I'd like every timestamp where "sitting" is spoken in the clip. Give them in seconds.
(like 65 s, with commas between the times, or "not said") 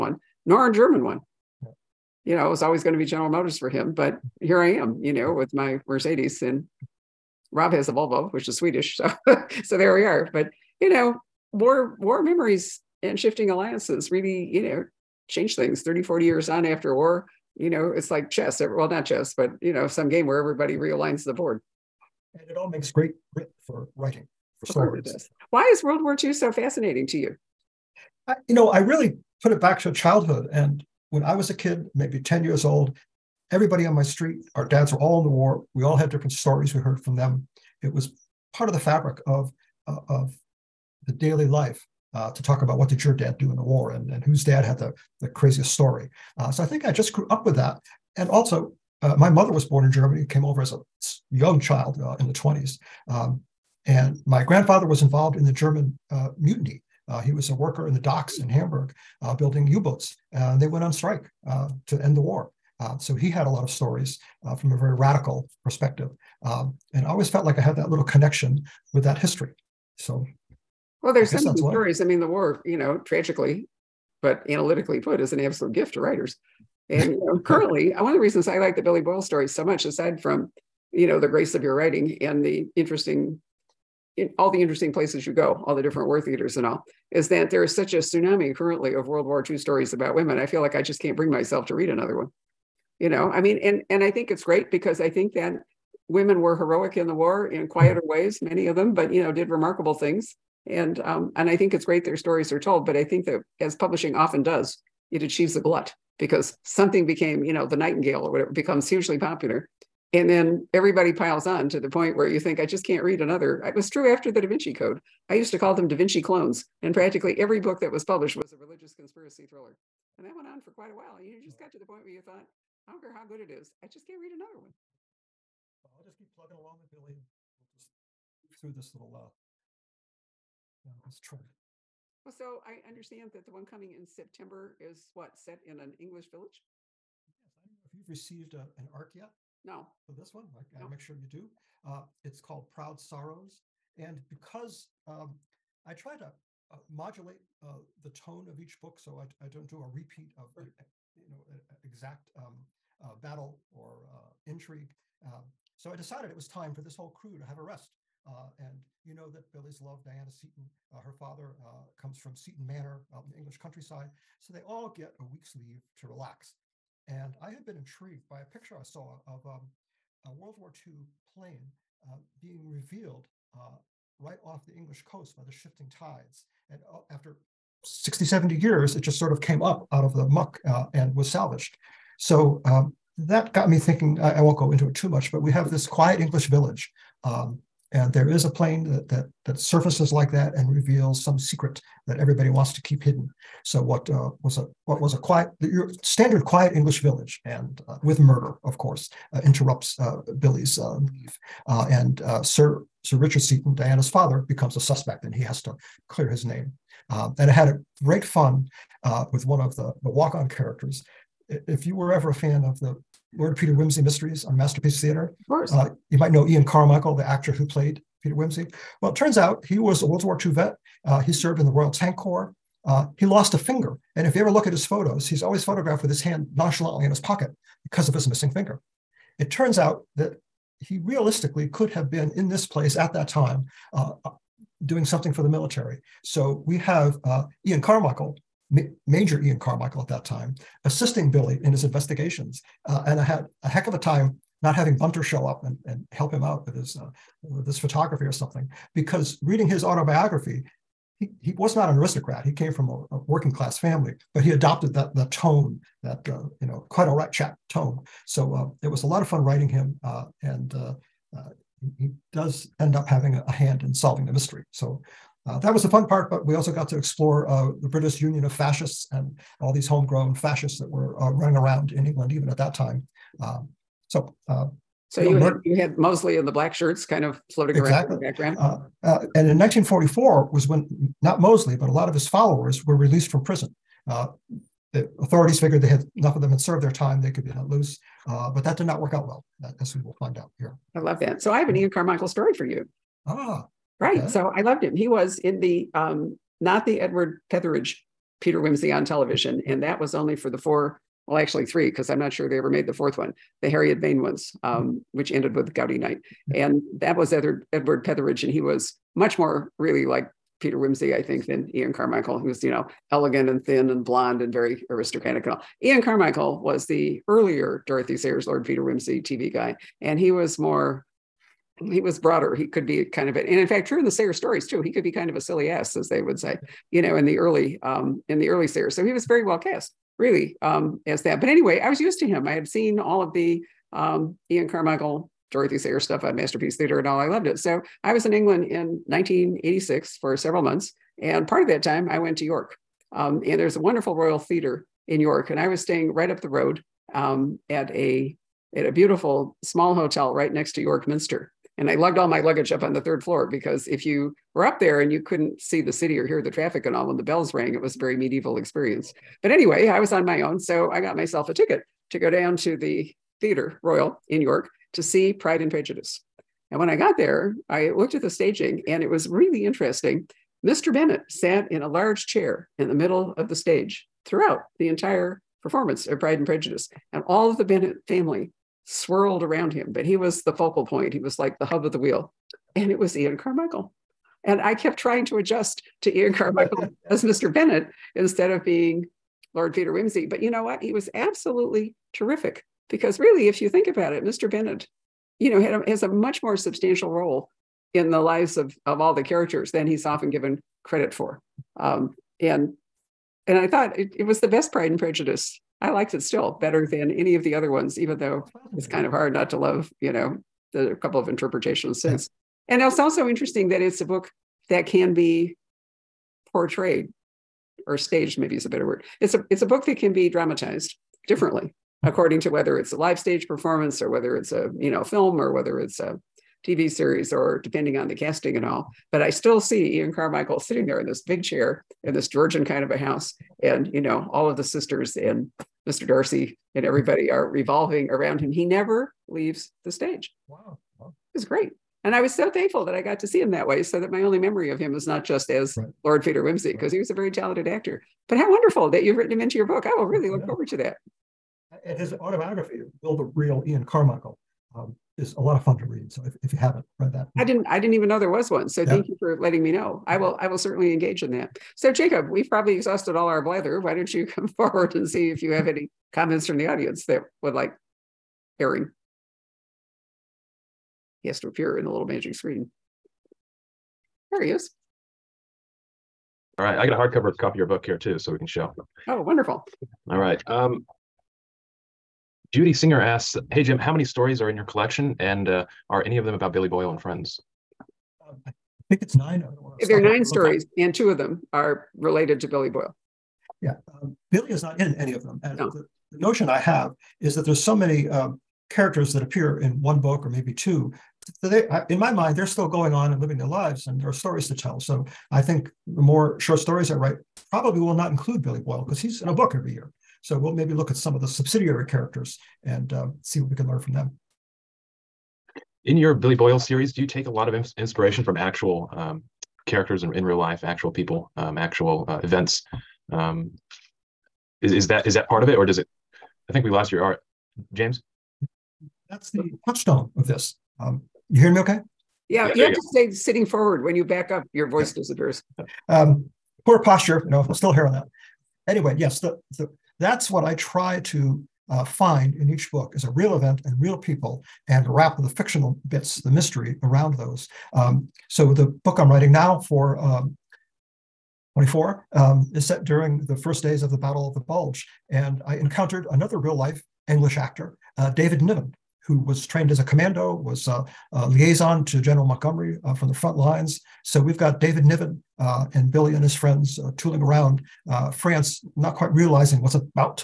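430 s, 533 s.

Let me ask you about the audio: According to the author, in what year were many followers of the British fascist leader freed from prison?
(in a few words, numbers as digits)
1944.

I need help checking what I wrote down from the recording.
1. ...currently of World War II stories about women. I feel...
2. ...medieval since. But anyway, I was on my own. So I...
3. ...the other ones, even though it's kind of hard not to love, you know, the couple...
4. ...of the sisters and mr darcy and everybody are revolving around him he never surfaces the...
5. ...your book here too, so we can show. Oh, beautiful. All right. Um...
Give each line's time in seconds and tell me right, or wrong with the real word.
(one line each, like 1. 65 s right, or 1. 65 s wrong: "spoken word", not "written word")
1. 88 s right
2. 358 s wrong: "experience", not "since"
3. 407 s right
4. 434 s wrong: "leaves", not "surfaces"
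5. 477 s wrong: "wonderful", not "beautiful".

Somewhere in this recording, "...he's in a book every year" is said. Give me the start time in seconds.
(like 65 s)
508 s.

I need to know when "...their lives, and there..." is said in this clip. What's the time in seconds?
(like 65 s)
503 s.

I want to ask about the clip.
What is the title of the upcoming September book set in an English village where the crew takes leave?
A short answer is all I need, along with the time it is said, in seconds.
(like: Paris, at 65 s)
Proud Sorrows, at 142 s.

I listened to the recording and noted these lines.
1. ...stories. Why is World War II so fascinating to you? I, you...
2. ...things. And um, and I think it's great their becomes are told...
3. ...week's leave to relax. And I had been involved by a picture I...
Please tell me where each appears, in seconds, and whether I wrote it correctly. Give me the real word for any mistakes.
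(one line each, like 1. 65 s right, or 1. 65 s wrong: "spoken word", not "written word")
1. 24 s right
2. 99 s wrong: "stories", not "becomes"
3. 165 s wrong: "intrigued", not "involved".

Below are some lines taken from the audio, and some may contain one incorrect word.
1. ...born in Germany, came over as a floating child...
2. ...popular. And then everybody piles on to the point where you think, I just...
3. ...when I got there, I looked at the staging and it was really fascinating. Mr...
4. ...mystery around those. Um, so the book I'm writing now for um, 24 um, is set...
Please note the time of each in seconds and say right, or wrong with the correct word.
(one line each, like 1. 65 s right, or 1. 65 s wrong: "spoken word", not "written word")
1. 49 s wrong: "young", not "floating"
2. 109 s right
3. 366 s wrong: "interesting", not "fascinating"
4. 546 s right.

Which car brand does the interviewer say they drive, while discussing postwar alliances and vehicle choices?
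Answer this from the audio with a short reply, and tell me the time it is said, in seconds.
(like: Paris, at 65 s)
Mercedes, at 5 s.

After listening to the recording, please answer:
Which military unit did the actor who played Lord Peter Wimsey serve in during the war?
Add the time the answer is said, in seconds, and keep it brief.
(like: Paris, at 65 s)
Royal Tank Corps, at 221 s.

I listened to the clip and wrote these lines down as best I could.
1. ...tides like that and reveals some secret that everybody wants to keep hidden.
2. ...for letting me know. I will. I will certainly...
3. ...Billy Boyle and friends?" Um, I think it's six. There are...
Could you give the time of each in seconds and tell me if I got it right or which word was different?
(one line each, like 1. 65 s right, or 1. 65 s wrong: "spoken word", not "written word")
1. 189 s wrong: "surfaces", not "tides"
2. 459 s right
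3. 486 s wrong: "nine", not "six".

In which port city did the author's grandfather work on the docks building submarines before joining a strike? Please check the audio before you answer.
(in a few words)
Hamburg.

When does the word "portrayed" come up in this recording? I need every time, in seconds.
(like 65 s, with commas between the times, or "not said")
416 s.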